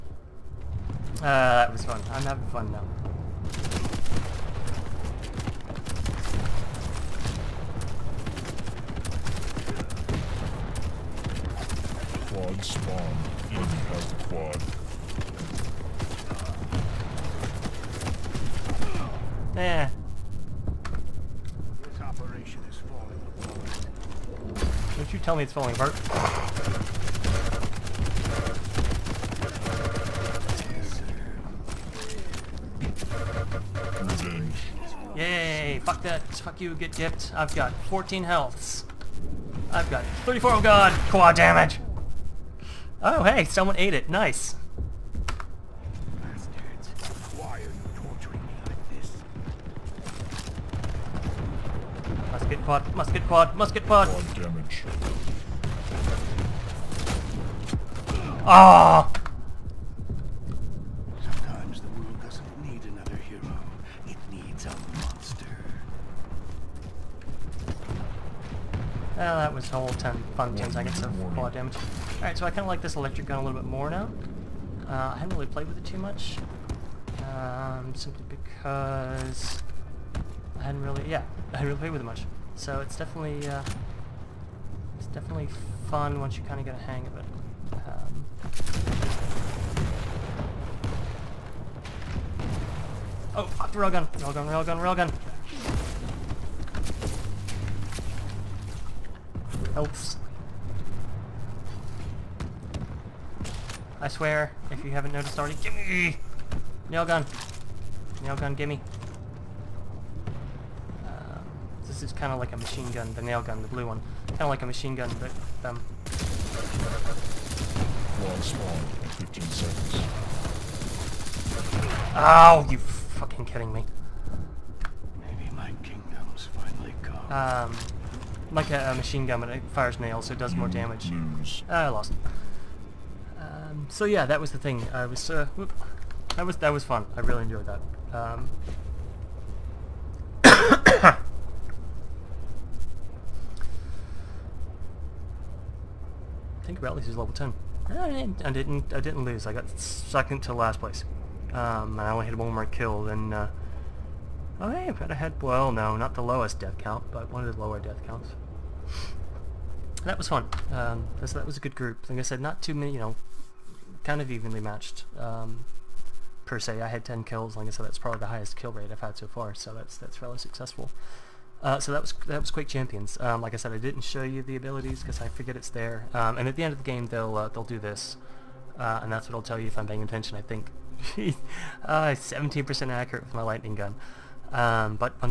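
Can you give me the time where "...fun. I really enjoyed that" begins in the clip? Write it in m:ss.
2:16.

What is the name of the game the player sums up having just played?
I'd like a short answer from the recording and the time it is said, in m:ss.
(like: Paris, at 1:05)
Quake Champions, at 2:52.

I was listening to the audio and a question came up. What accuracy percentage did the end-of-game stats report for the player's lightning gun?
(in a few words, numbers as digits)
17%.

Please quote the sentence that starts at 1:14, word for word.
Uh, I haven't really played with it too much.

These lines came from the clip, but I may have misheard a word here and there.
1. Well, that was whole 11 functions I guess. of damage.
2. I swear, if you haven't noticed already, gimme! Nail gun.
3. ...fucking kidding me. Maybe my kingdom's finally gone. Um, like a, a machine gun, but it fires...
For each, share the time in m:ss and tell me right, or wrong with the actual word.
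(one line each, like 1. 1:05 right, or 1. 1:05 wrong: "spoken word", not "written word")
1. 1:09 wrong: "10", not "11"
2. 1:43 right
3. 2:02 right.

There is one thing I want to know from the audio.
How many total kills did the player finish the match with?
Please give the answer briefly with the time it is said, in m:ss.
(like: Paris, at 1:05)
10, at 2:46.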